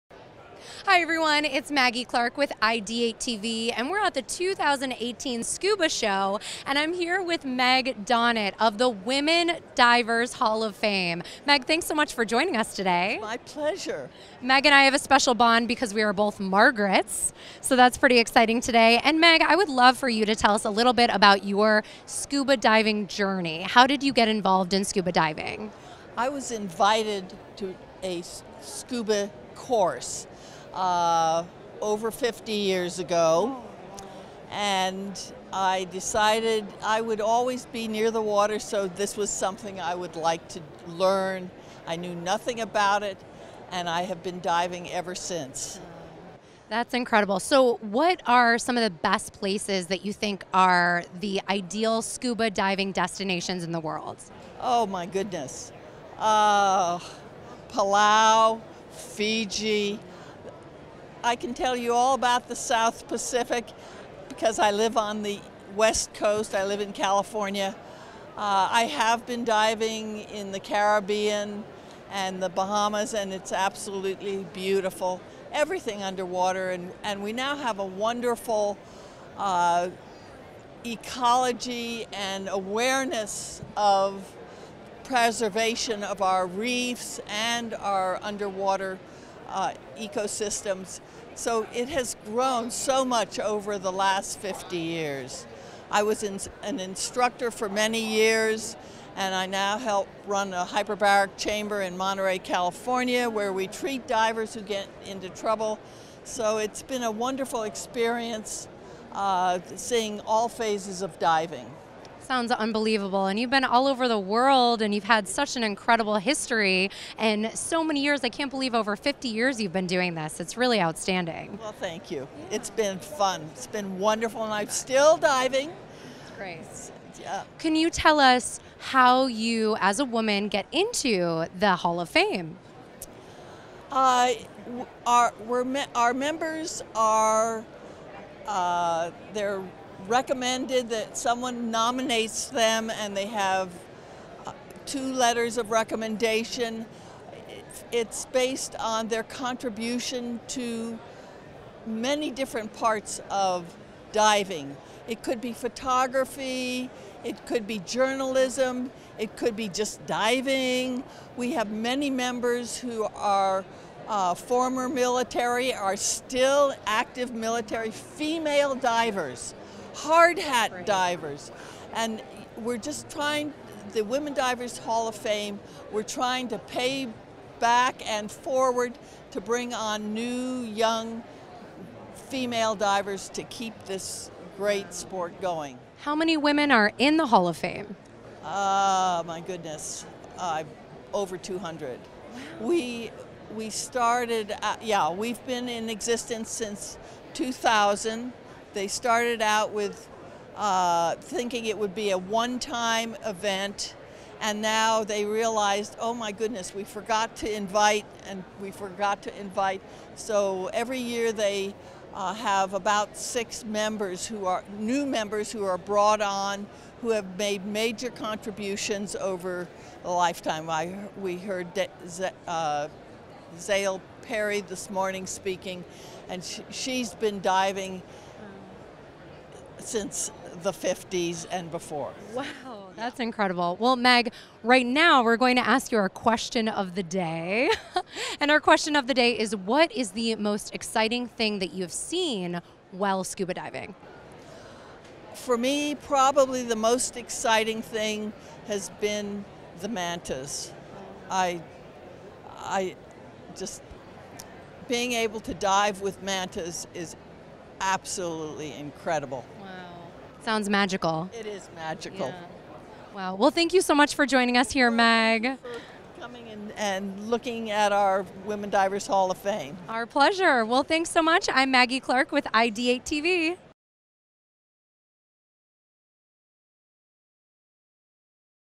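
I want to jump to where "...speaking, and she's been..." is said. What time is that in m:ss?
3:45.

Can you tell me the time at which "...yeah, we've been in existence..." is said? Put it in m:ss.
3:14.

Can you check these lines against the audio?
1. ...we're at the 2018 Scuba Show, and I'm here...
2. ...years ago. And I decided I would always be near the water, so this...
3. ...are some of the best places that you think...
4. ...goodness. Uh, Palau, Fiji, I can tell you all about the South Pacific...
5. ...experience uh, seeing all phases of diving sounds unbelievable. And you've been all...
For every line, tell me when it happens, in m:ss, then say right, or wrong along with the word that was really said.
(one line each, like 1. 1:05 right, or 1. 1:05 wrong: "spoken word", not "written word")
1. 0:03 right
2. 0:32 right
3. 0:48 right
4. 0:55 right
5. 1:47 right.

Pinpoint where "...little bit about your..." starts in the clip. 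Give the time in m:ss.
0:20.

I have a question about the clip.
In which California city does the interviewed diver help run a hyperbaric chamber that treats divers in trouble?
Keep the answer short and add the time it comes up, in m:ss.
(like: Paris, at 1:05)
Monterey, at 1:41.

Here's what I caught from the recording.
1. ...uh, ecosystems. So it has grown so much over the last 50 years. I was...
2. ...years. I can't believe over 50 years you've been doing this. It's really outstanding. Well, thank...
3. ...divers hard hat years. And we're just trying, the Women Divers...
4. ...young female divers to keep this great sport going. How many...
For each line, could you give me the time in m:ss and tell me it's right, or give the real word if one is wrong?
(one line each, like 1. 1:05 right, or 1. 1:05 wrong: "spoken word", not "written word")
1. 1:29 right
2. 1:58 right
3. 2:48 wrong: "divers", not "years"
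4. 3:00 right.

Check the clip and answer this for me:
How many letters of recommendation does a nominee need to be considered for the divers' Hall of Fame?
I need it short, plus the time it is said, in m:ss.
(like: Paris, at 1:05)
2, at 2:24.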